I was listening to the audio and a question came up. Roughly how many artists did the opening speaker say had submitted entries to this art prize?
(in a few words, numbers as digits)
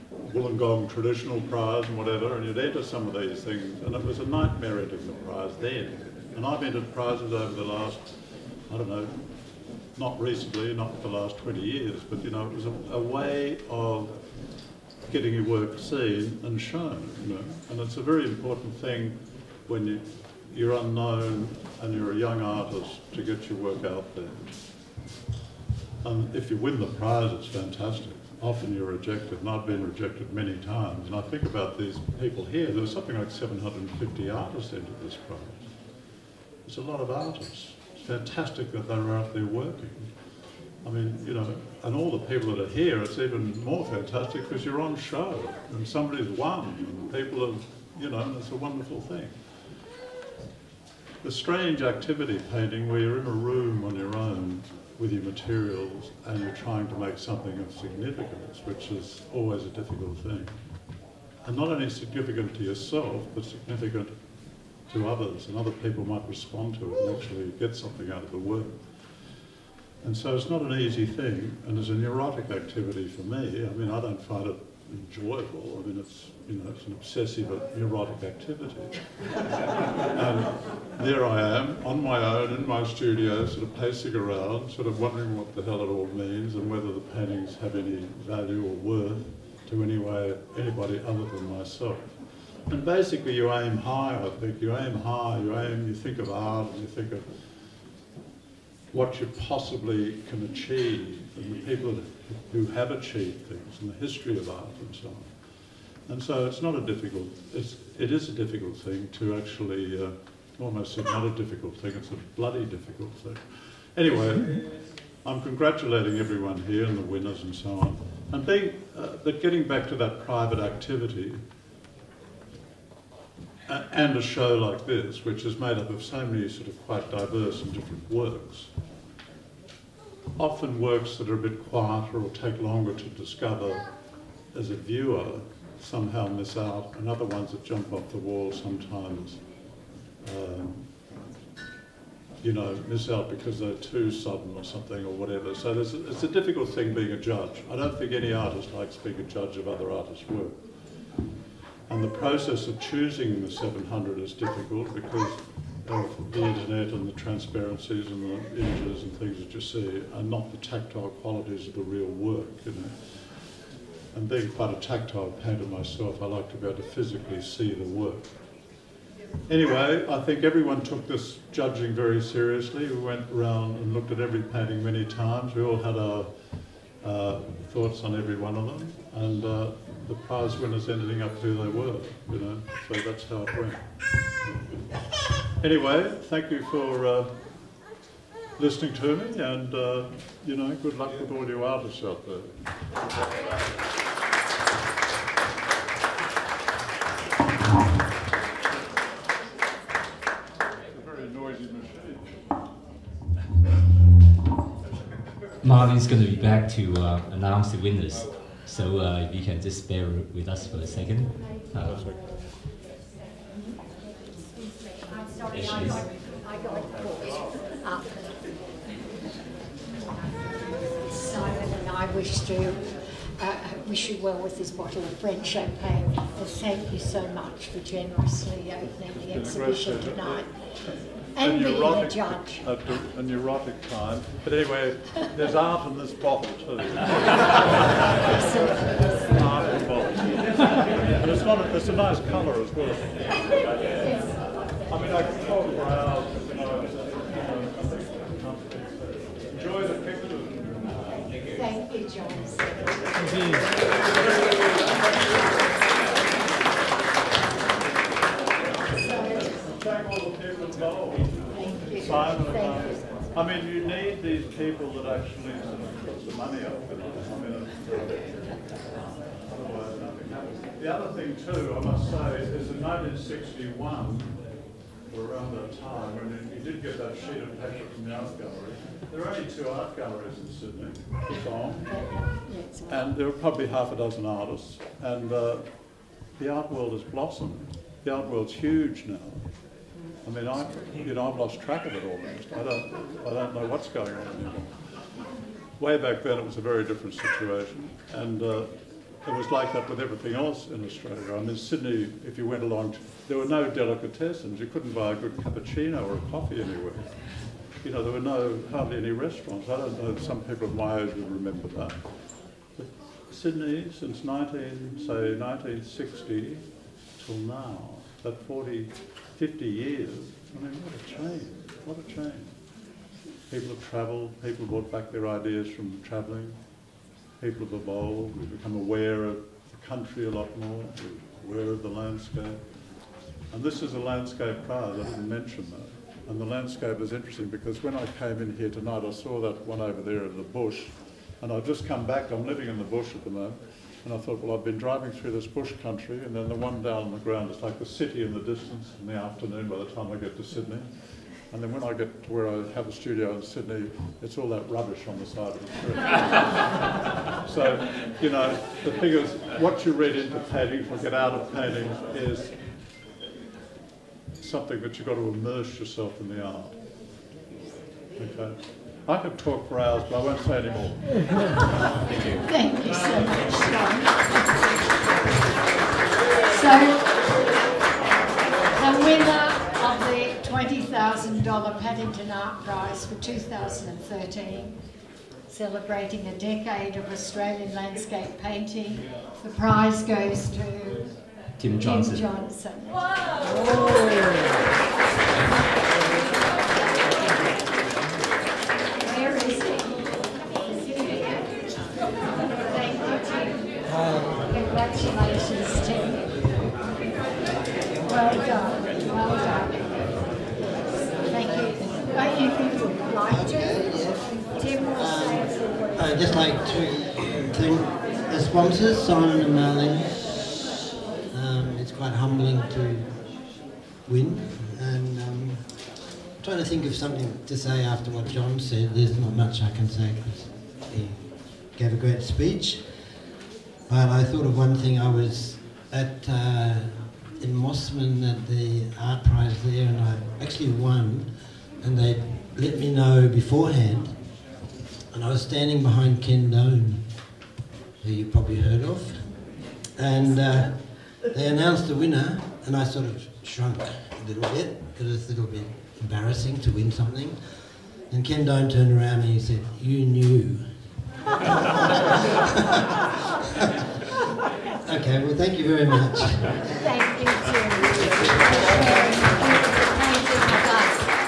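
750.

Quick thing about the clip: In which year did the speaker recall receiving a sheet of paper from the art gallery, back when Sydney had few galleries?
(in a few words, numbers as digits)
1961.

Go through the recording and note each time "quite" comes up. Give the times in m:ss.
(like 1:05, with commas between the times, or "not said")
2:06, 2:44, 7:01.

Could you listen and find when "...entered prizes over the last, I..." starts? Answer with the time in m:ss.
0:06.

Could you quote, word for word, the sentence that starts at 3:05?
Anyway, thank you for uh, listening to me, and uh, you know, good luck with all you artists out there.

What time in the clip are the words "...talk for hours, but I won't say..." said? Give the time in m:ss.
6:09.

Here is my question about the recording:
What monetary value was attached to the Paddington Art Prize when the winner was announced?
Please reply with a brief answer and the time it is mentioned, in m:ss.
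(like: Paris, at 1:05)
$1,000, at 6:21.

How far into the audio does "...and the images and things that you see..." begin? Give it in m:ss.
2:38.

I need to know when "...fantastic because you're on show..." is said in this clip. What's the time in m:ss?
0:43.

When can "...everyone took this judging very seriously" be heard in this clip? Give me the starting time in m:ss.
2:50.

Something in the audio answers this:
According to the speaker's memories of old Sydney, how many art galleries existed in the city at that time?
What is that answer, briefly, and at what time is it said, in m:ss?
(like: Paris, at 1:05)
2, at 4:39.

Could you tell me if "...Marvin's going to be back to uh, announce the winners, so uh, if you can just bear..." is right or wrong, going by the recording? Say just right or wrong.
right.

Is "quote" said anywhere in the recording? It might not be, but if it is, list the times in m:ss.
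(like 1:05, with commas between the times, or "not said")
not said.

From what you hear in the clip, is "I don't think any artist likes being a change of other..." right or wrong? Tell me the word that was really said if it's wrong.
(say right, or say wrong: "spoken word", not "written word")
wrong: "judge", not "change".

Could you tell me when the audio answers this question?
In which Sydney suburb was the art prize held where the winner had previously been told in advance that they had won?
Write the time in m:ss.
7:17.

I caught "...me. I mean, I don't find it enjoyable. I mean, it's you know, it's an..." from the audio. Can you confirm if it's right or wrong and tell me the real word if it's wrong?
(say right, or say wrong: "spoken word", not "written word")
right.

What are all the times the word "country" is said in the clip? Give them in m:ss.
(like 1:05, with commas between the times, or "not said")
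5:29, 5:45.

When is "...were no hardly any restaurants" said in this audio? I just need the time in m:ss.
5:08.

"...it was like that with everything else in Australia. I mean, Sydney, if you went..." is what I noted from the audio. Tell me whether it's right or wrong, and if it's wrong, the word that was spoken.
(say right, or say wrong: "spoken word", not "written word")
right.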